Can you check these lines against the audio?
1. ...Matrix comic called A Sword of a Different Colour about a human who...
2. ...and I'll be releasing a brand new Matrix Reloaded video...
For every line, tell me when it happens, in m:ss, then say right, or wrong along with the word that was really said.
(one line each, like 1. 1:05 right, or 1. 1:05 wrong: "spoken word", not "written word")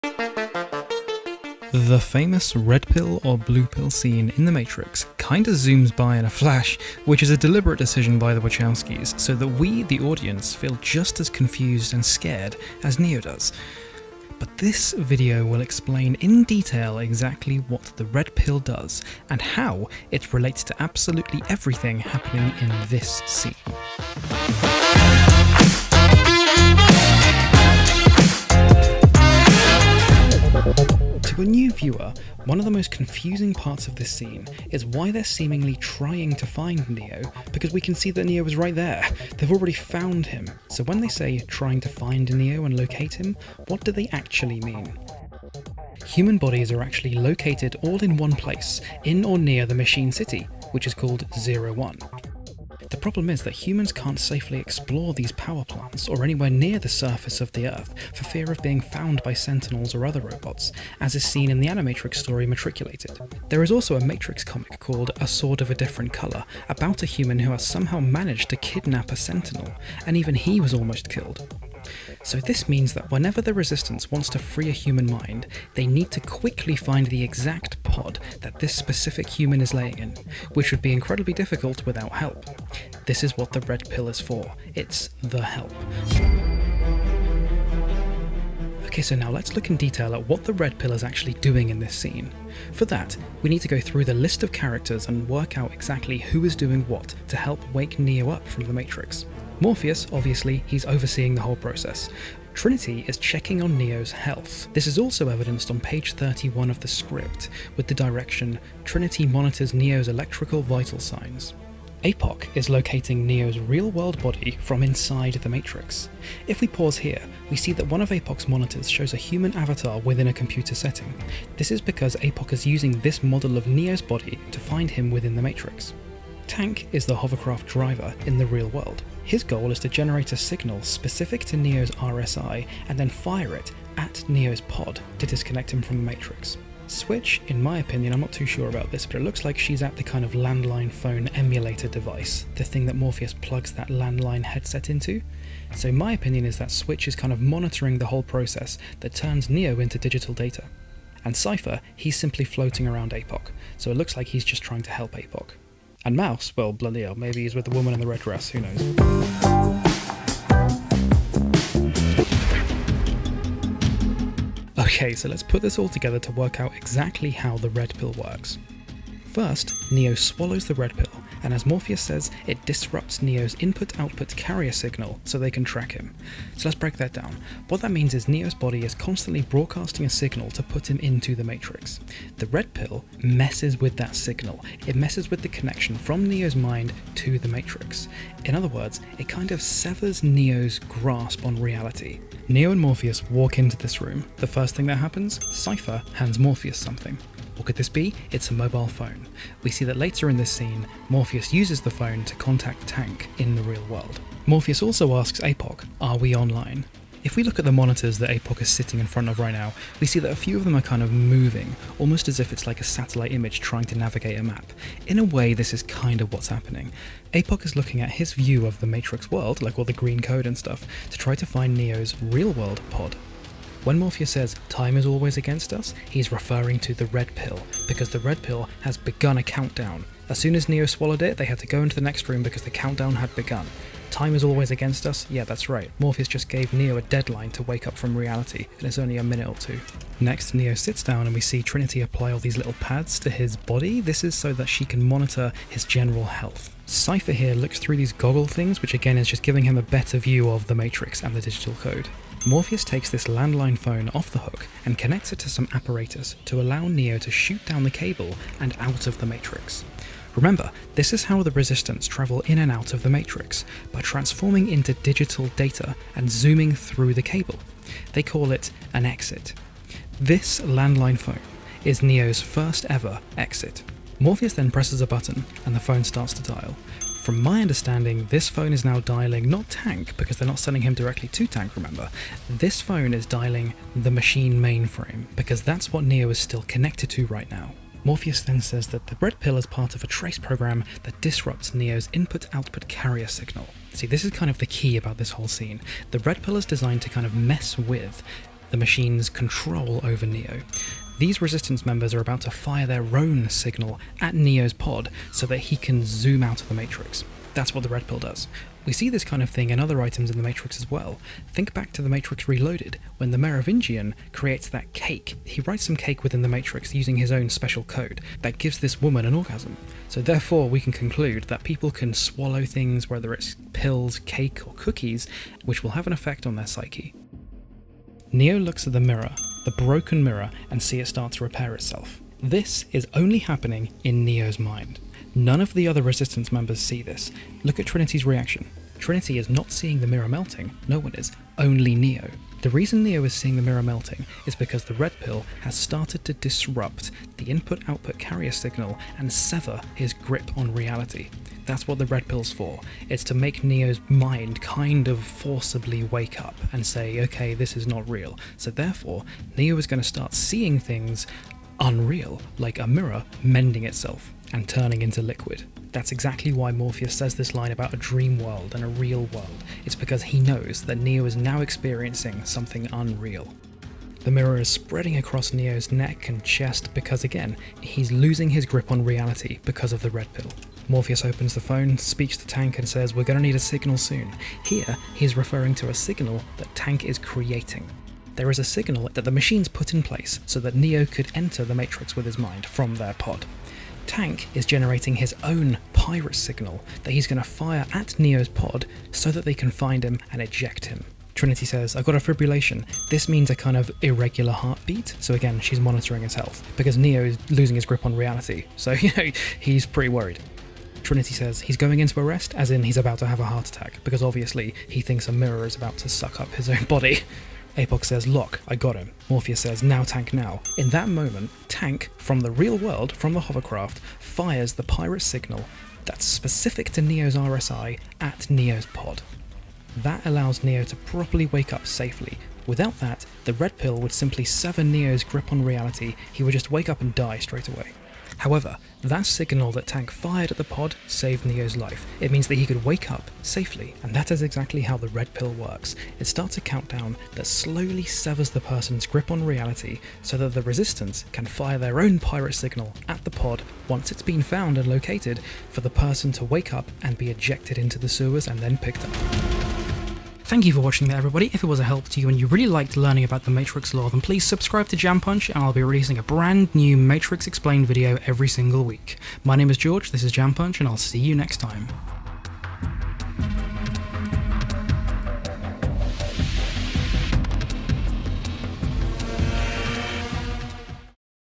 1. 1:04 right
2. 7:45 wrong: "Explained", not "Reloaded".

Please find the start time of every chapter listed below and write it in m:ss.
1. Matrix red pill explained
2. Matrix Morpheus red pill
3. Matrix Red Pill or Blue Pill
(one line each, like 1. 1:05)
1. 2:41
2. 1:25
3. 0:30.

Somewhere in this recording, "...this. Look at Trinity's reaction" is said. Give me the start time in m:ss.
5:37.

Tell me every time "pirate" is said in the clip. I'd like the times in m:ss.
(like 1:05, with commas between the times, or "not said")
6:35, 7:04, 7:32.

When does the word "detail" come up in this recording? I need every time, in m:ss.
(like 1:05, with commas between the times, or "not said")
0:16, 1:29.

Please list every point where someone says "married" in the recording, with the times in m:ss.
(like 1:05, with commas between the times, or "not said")
not said.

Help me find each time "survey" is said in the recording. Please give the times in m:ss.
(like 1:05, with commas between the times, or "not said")
not said.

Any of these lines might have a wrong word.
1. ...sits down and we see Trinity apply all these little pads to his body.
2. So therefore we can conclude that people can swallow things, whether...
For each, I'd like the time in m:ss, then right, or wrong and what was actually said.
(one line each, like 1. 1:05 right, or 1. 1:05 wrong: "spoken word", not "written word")
1. 4:00 right
2. 5:20 right.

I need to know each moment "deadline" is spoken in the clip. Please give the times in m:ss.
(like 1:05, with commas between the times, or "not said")
3:57.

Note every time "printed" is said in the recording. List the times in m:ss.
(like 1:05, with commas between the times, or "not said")
not said.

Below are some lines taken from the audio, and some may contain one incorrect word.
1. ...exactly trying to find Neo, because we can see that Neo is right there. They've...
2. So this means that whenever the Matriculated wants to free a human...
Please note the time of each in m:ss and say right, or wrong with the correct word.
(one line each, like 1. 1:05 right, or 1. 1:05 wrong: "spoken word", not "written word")
1. 0:35 wrong: "seemingly", not "exactly"
2. 1:12 wrong: "Resistance", not "Matriculated".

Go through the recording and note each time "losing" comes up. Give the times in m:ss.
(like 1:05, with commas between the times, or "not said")
6:18, 6:47.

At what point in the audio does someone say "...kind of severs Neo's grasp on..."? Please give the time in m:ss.
3:09.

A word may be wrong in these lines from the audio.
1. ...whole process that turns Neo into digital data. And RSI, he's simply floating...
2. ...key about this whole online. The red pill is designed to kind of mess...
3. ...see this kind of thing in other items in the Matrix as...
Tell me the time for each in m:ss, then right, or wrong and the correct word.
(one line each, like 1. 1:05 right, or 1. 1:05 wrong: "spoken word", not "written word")
1. 2:28 wrong: "Cypher", not "RSI"
2. 4:54 wrong: "scene", not "online"
3. 5:08 right.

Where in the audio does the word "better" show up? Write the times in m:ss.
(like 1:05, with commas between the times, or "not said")
4:09.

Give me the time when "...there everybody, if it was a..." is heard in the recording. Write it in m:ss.
7:41.